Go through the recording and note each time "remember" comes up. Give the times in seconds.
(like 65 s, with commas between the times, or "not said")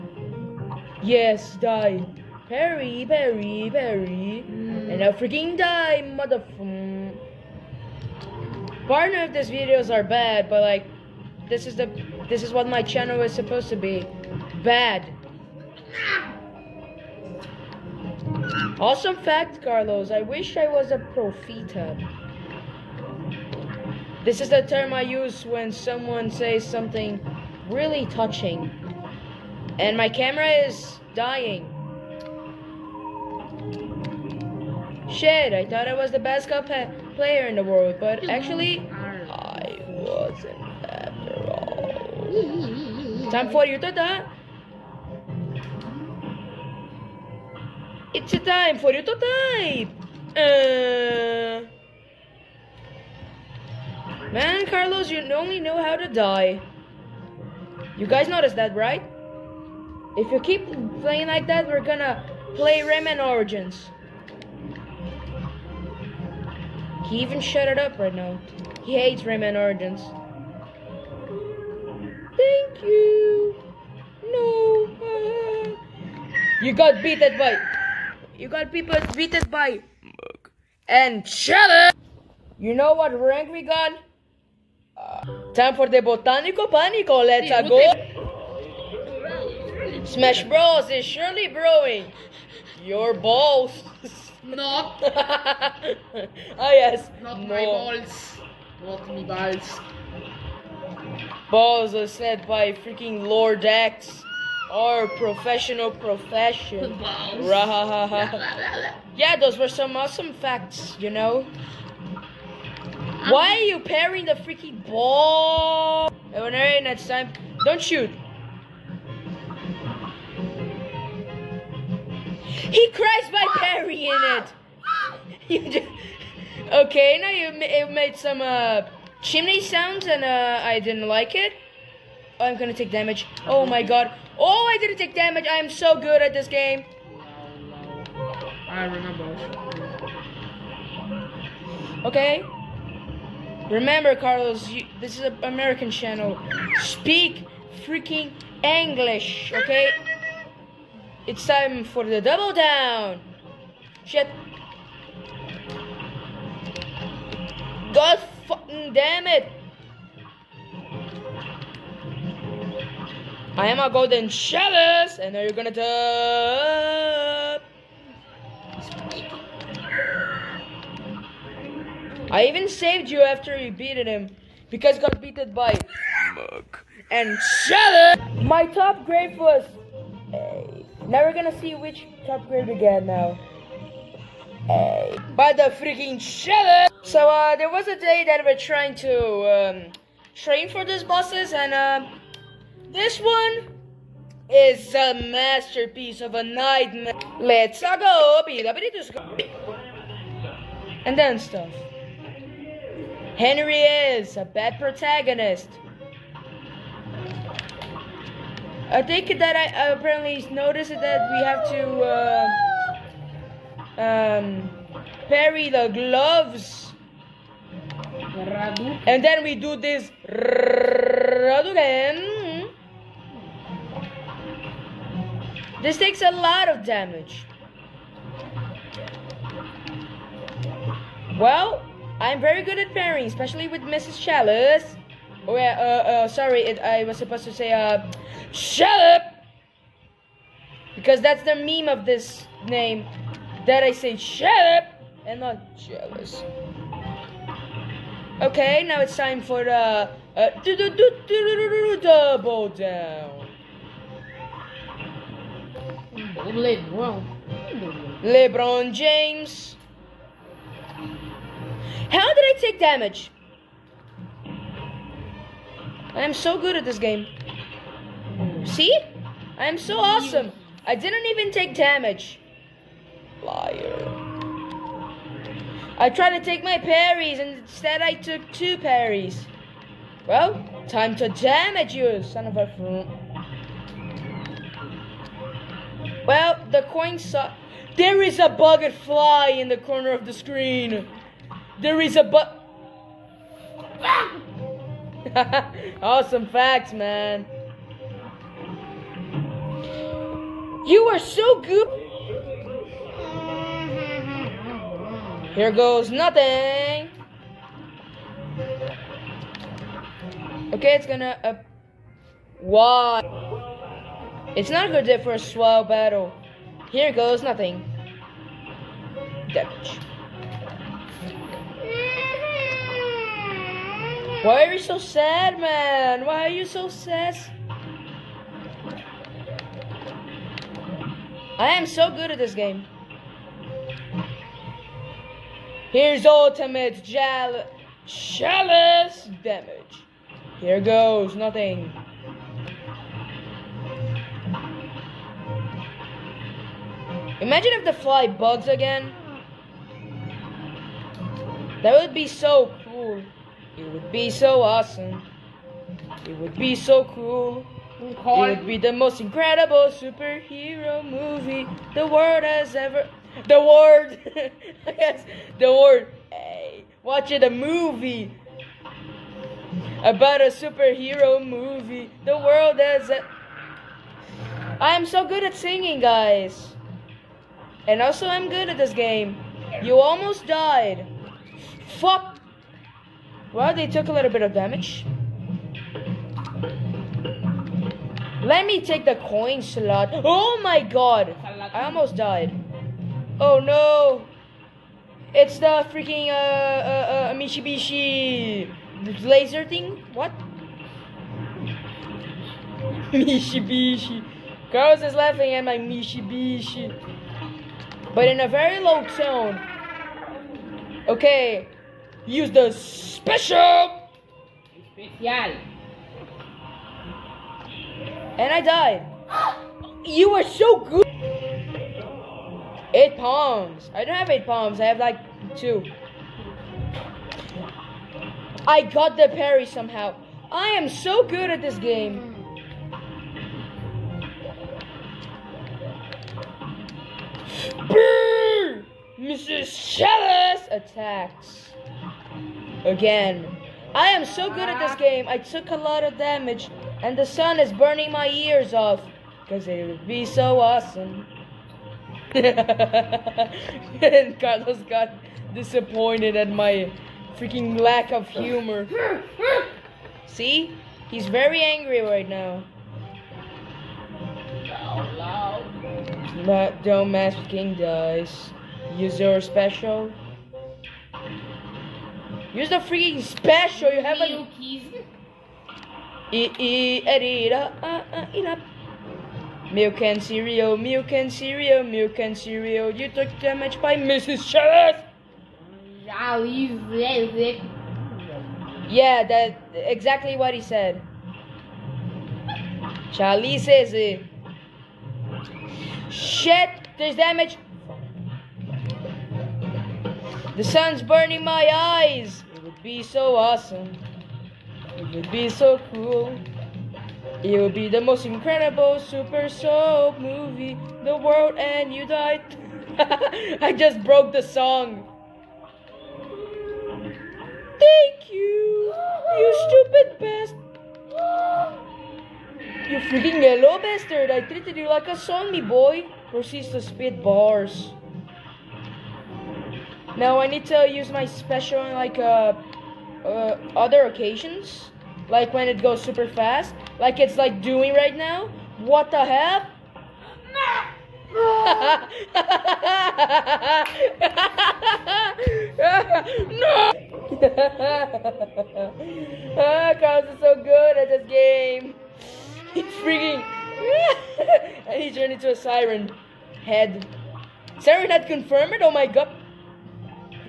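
138 s, 143 s.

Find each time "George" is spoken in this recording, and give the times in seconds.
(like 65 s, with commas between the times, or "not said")
not said.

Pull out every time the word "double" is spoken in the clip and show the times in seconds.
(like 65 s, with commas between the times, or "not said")
152 s, 252 s.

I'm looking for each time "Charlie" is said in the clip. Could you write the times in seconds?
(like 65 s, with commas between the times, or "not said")
493 s.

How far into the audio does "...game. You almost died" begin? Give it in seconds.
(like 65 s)
378 s.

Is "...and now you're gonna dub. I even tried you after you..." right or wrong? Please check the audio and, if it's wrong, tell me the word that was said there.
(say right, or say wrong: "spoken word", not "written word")
wrong: "saved", not "tried".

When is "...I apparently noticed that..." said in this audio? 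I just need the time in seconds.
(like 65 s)
209 s.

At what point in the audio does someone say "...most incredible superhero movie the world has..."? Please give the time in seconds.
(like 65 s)
358 s.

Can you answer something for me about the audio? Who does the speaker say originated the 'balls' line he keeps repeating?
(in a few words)
Lord X.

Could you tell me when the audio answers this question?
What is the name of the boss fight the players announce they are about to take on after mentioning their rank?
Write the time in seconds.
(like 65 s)
86 s.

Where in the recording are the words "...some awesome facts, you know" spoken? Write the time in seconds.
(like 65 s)
109 s.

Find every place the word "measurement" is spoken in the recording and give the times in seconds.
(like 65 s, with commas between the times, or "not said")
not said.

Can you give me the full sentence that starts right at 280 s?
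Well, time to damage you, son of a...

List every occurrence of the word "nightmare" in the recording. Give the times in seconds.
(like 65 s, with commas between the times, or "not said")
196 s.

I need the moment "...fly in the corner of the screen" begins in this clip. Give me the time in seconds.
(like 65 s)
289 s.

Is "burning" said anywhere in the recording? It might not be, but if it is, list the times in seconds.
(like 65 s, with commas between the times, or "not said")
447 s, 501 s.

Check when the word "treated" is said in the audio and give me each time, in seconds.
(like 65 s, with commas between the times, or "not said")
524 s.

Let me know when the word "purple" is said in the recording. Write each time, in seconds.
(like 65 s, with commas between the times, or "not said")
not said.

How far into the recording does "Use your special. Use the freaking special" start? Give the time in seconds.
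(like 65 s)
468 s.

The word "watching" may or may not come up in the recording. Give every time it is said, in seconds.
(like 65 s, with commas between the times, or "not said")
367 s.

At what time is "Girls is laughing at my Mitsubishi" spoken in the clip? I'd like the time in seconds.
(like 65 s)
404 s.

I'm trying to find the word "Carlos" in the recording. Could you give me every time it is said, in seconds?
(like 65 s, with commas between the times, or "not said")
19 s, 54 s, 144 s, 454 s, 549 s.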